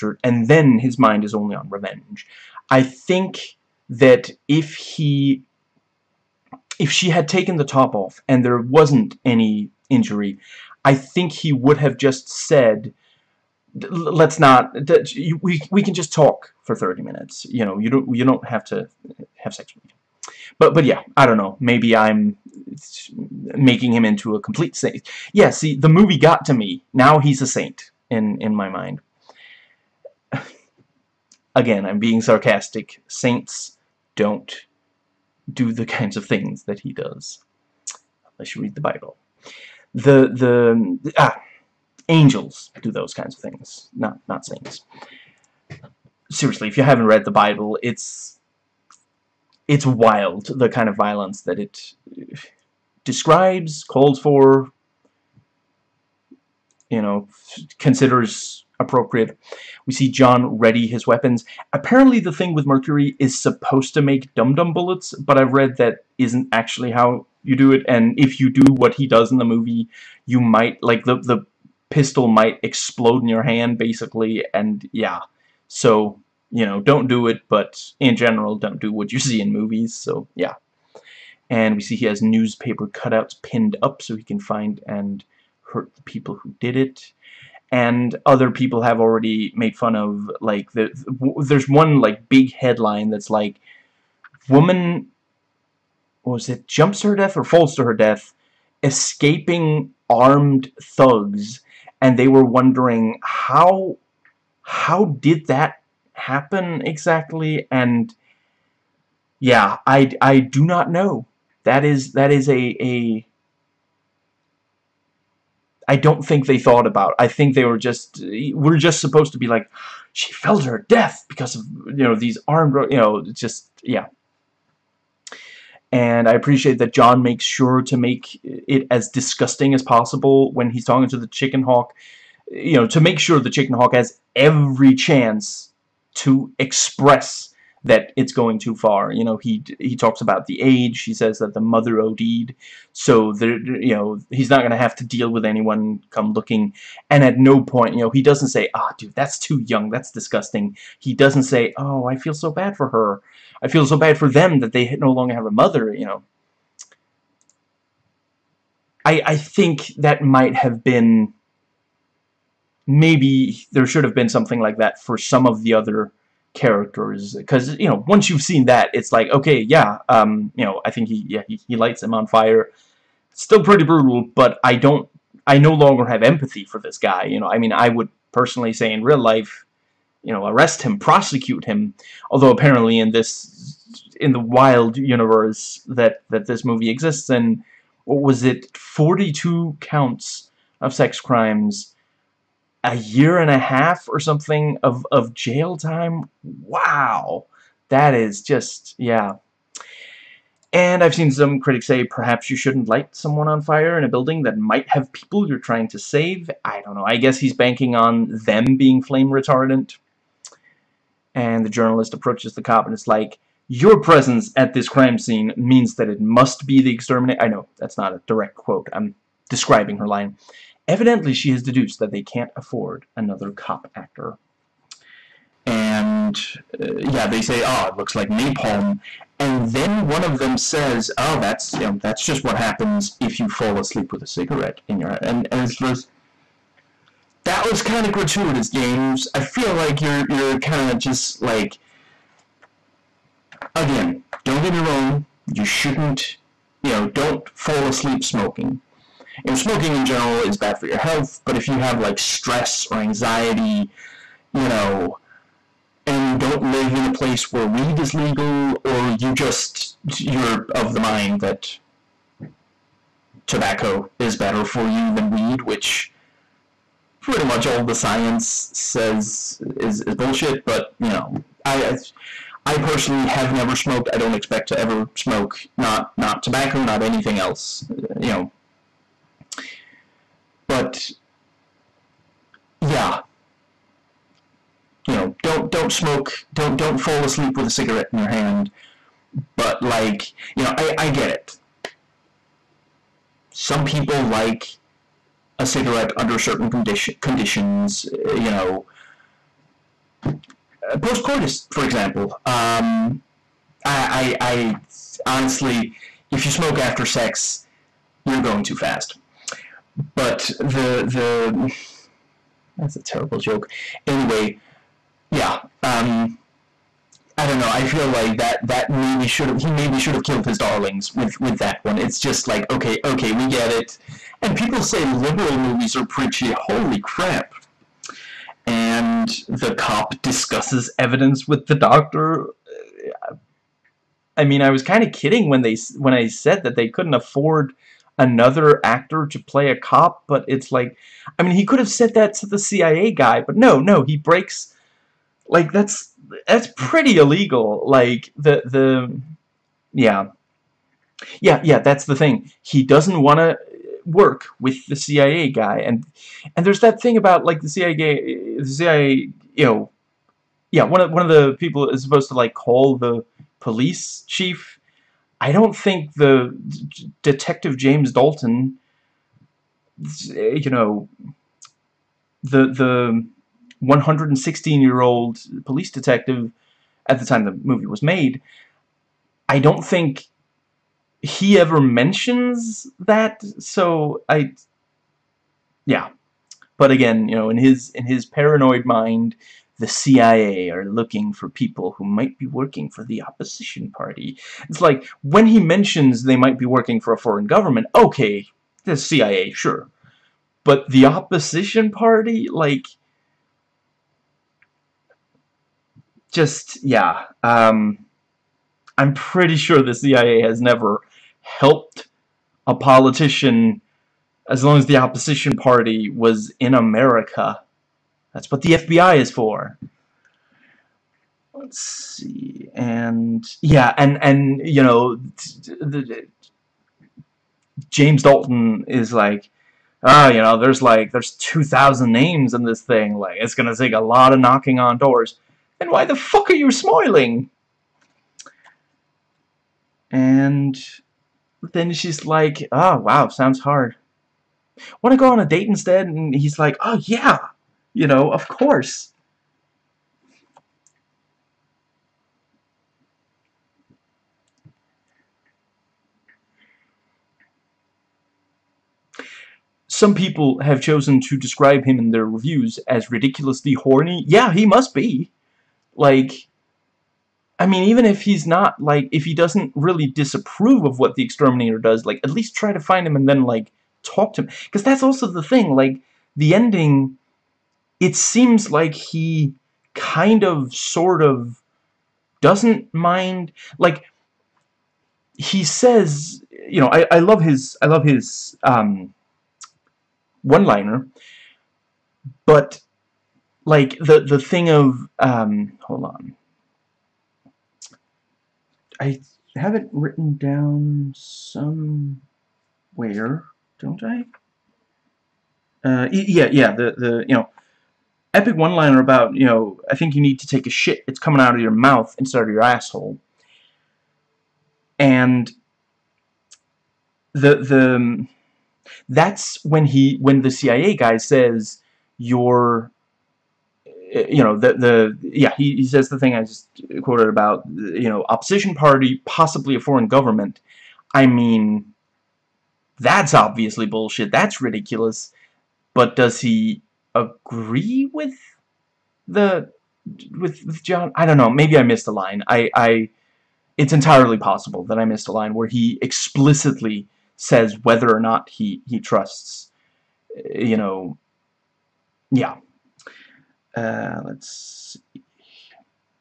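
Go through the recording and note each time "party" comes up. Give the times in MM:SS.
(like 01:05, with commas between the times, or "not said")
06:33, 06:41, 06:55, 08:48.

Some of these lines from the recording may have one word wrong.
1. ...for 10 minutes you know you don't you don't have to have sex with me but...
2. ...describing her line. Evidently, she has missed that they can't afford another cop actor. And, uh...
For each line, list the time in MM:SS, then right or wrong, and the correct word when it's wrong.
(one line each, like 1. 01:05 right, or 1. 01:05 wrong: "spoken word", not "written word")
1. 00:16 wrong: "30", not "10"
2. 03:39 wrong: "deduced", not "missed".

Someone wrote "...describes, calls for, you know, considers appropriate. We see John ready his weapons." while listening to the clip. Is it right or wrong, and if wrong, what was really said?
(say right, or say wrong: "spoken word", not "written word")
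right.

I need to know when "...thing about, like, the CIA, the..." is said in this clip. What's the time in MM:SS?
05:56.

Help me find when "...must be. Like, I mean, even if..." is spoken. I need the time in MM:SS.
07:44.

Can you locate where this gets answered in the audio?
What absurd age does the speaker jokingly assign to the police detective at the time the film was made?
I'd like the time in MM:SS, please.
06:13.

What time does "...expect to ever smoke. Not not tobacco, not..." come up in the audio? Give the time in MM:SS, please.
04:34.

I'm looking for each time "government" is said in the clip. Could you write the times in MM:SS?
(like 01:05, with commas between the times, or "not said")
06:37, 08:50.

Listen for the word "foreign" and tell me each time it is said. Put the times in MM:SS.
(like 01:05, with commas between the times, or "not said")
06:37, 08:49.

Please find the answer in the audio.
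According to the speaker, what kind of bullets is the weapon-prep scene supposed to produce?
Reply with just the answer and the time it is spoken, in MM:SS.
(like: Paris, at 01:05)
dum-dum bullets, at 01:04.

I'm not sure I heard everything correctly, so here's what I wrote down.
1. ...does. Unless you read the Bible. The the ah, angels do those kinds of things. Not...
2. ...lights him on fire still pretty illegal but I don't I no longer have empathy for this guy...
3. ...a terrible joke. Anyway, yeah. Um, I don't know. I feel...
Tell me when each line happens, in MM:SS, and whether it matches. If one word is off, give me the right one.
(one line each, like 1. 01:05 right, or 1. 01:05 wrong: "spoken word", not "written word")
1. 00:36 right
2. 02:51 wrong: "brutal", not "illegal"
3. 05:12 right.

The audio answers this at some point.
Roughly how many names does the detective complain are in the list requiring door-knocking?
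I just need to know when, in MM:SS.
07:11.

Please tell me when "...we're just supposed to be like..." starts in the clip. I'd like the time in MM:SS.
01:58.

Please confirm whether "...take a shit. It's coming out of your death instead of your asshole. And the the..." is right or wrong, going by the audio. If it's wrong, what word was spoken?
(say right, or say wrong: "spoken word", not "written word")
wrong: "mouth", not "death".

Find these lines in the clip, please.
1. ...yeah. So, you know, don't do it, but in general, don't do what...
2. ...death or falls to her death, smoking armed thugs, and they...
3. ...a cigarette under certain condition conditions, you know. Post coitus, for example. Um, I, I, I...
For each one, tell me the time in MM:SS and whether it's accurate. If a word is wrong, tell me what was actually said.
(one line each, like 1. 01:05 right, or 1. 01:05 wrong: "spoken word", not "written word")
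1. 01:14 right
2. 01:37 wrong: "escaping", not "smoking"
3. 04:55 right.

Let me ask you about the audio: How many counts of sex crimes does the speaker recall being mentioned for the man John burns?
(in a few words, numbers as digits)
42.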